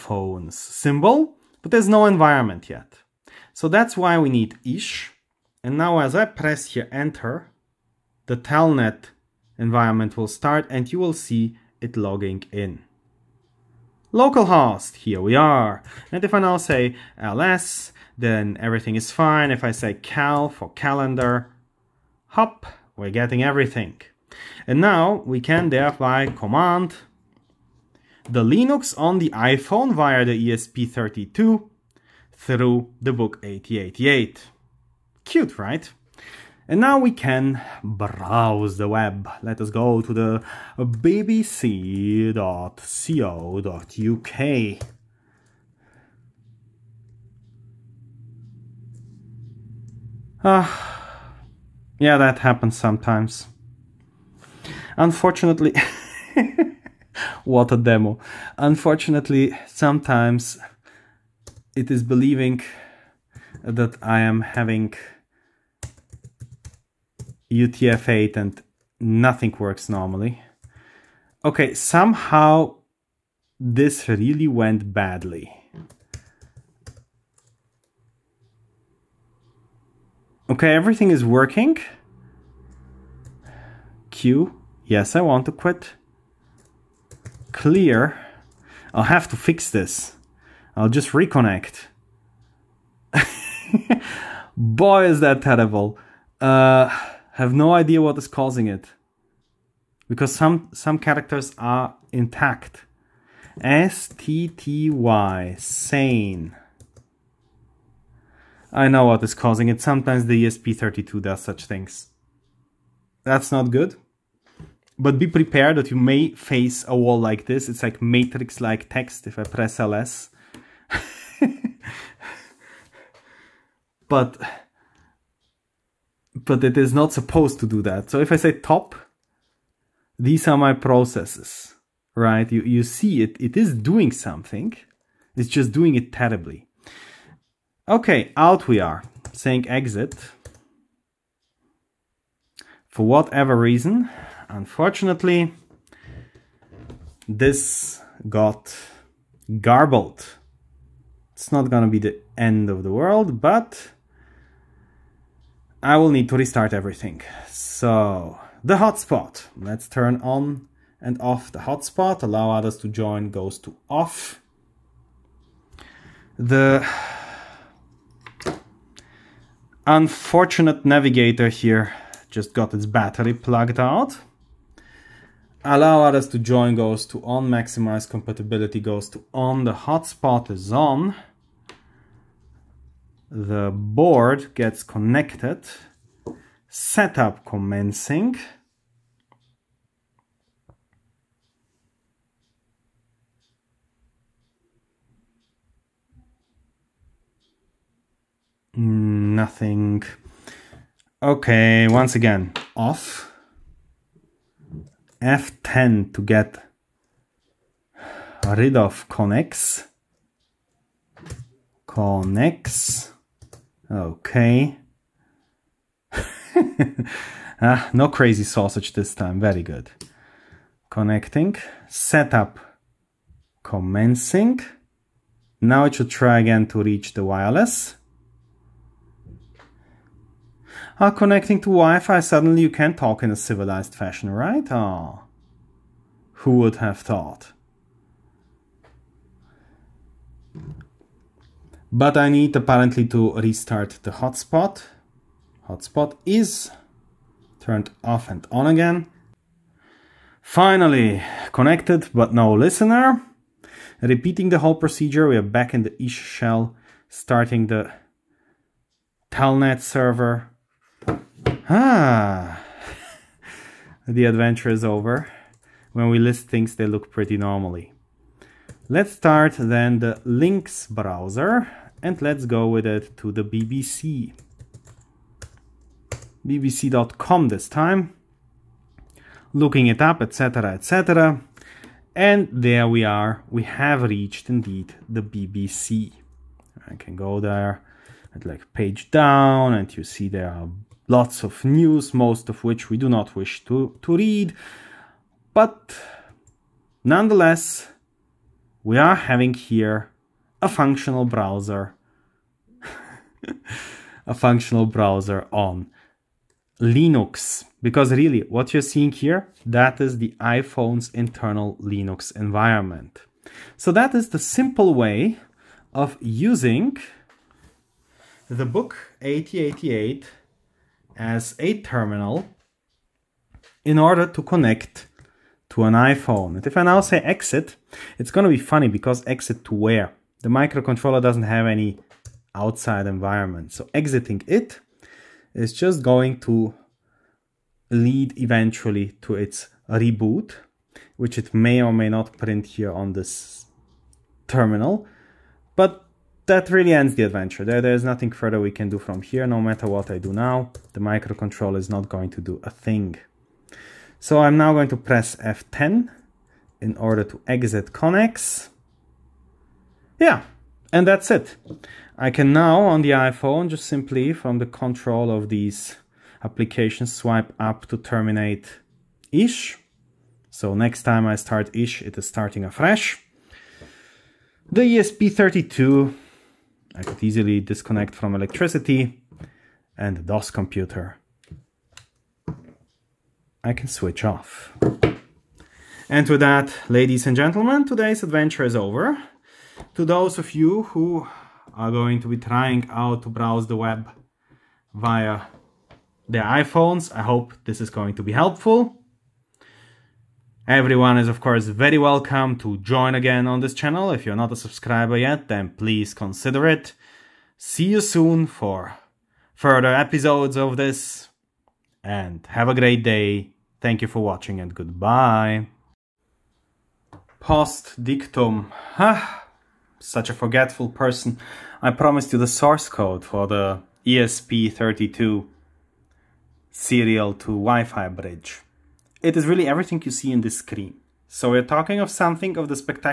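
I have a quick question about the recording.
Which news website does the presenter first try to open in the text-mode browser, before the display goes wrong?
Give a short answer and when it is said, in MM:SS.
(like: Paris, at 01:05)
bbc.co.uk, at 00:40.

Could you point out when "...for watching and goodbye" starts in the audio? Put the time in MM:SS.
06:54.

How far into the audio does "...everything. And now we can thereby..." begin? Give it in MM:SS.
00:23.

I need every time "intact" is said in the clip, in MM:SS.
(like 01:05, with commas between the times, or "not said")
01:42.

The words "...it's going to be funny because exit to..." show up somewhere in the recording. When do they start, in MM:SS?
05:28.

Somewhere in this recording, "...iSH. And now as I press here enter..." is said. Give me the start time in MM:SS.
00:04.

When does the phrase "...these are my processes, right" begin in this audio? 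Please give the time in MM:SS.
02:10.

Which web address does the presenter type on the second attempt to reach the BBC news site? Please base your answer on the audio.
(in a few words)
BBC.com.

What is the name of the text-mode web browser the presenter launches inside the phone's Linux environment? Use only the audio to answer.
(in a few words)
Links.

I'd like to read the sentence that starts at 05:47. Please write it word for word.
There, there's nothing further we can do from here.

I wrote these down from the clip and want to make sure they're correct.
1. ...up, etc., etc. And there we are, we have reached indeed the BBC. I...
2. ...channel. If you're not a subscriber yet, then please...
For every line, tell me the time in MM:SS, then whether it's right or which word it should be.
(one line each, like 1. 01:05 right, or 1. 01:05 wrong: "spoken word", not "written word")
1. 04:40 right
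2. 06:43 right.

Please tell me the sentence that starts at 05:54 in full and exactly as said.
So I'm now going to press F10 in order to exit Connex.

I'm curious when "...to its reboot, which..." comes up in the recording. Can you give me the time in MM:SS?
05:39.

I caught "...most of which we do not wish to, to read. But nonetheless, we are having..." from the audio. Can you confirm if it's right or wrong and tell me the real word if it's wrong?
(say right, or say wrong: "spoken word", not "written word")
right.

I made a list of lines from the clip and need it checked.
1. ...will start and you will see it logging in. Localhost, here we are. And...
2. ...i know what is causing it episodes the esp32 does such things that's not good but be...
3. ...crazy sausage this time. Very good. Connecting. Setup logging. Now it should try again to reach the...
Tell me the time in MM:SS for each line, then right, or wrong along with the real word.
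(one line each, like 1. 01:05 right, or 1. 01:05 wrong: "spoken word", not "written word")
1. 00:10 right
2. 01:48 wrong: "sometimes", not "episodes"
3. 03:38 wrong: "commencing", not "logging".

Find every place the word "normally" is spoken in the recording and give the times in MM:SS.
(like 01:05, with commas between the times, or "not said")
01:09, 04:27.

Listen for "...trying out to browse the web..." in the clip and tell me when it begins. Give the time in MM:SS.
06:32.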